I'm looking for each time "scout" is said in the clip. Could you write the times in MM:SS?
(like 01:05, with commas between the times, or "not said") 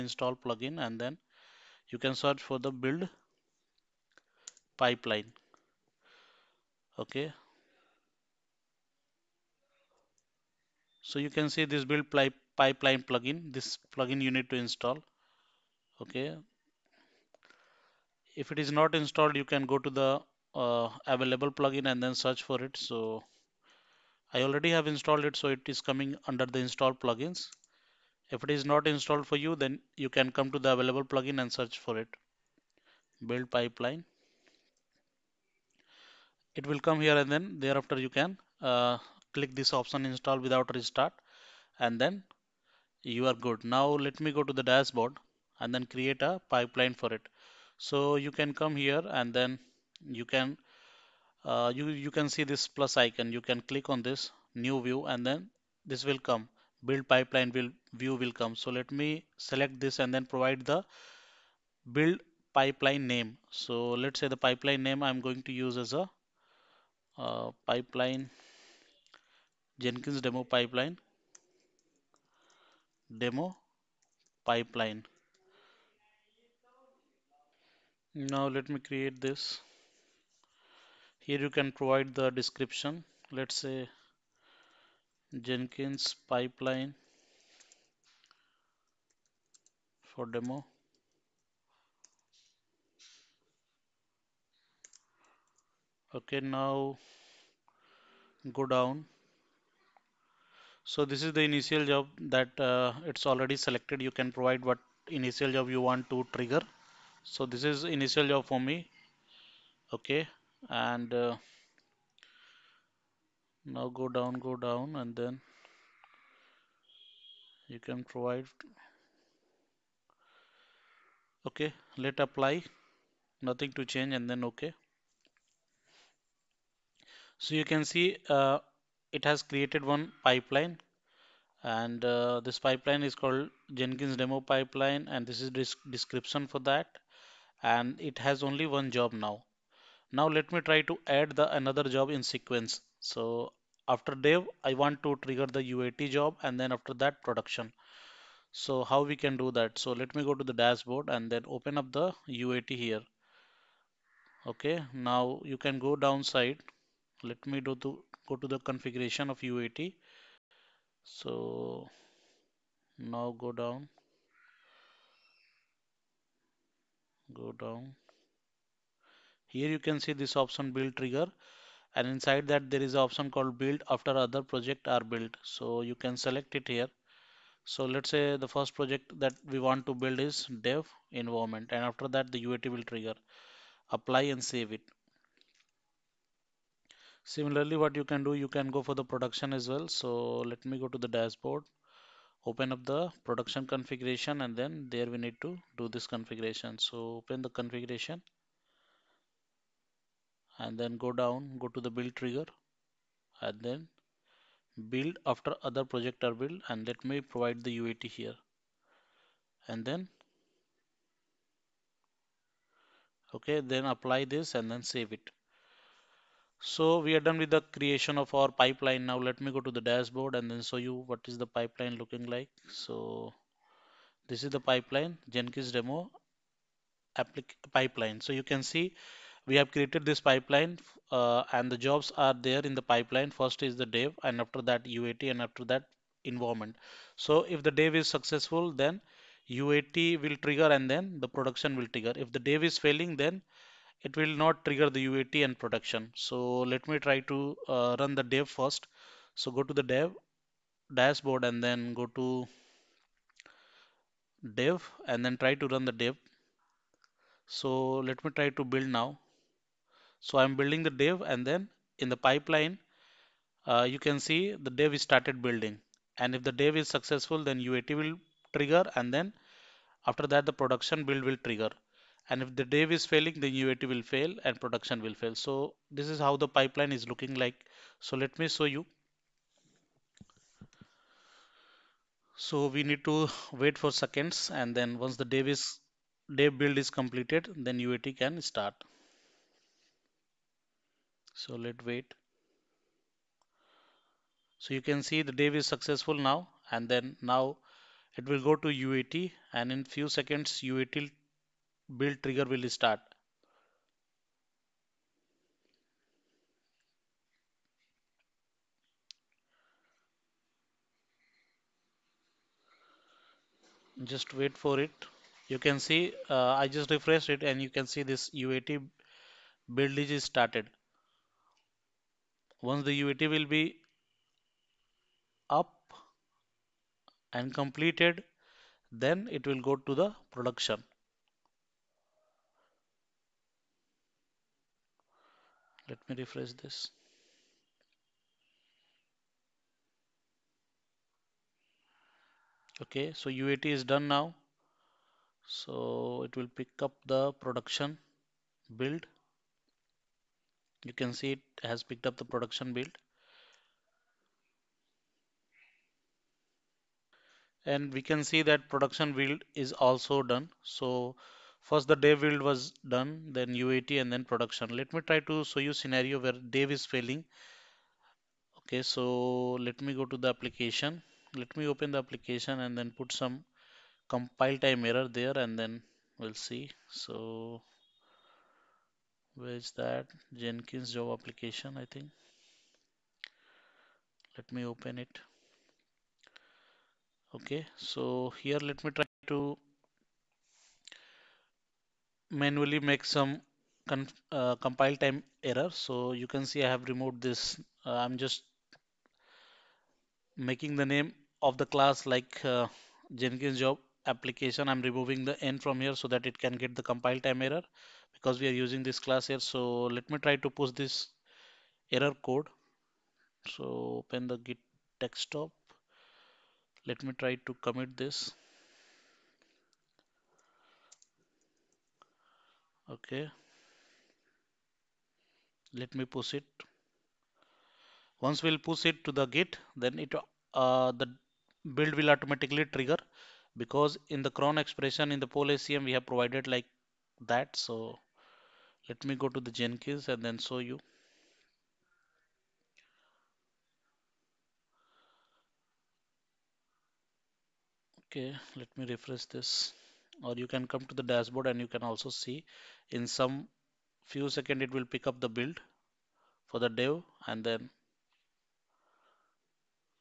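not said.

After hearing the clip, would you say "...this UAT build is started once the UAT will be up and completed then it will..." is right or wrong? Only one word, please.
right.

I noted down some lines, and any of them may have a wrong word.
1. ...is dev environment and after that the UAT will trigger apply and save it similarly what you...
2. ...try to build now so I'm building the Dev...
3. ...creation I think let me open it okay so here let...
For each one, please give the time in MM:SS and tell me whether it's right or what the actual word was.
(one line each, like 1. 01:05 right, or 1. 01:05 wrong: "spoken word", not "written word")
1. 03:00 right
2. 04:18 right
3. 06:21 wrong: "application", not "creation".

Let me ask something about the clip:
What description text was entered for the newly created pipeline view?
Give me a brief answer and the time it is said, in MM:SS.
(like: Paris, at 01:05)
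Jenkins pipeline for demo, at 01:25.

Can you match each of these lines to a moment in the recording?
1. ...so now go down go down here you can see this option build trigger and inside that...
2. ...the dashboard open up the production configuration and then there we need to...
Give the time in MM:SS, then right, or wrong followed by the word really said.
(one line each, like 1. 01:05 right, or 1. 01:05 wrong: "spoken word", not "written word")
1. 02:41 right
2. 03:11 right.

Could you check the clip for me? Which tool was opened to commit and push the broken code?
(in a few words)
Git desktop.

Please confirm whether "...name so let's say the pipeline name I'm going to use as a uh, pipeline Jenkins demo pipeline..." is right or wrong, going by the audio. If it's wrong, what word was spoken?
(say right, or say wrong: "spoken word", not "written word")
right.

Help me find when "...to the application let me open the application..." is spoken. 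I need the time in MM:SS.
06:10.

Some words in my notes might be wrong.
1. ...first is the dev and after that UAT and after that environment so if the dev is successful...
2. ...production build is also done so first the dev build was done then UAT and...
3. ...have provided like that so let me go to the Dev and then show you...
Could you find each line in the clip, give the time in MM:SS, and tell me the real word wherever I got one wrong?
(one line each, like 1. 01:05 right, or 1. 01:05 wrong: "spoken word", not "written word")
1. 03:53 right
2. 05:58 right
3. 07:15 wrong: "Jenkins", not "Dev".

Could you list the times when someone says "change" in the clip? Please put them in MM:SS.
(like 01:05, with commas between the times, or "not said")
02:03.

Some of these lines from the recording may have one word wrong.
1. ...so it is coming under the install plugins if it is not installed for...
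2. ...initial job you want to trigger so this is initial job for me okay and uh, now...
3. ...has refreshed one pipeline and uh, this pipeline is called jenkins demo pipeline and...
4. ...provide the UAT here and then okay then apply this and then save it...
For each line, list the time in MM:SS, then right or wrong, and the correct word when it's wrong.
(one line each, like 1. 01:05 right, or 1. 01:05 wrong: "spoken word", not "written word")
1. 00:25 right
2. 01:45 right
3. 02:09 wrong: "created", not "refreshed"
4. 03:27 right.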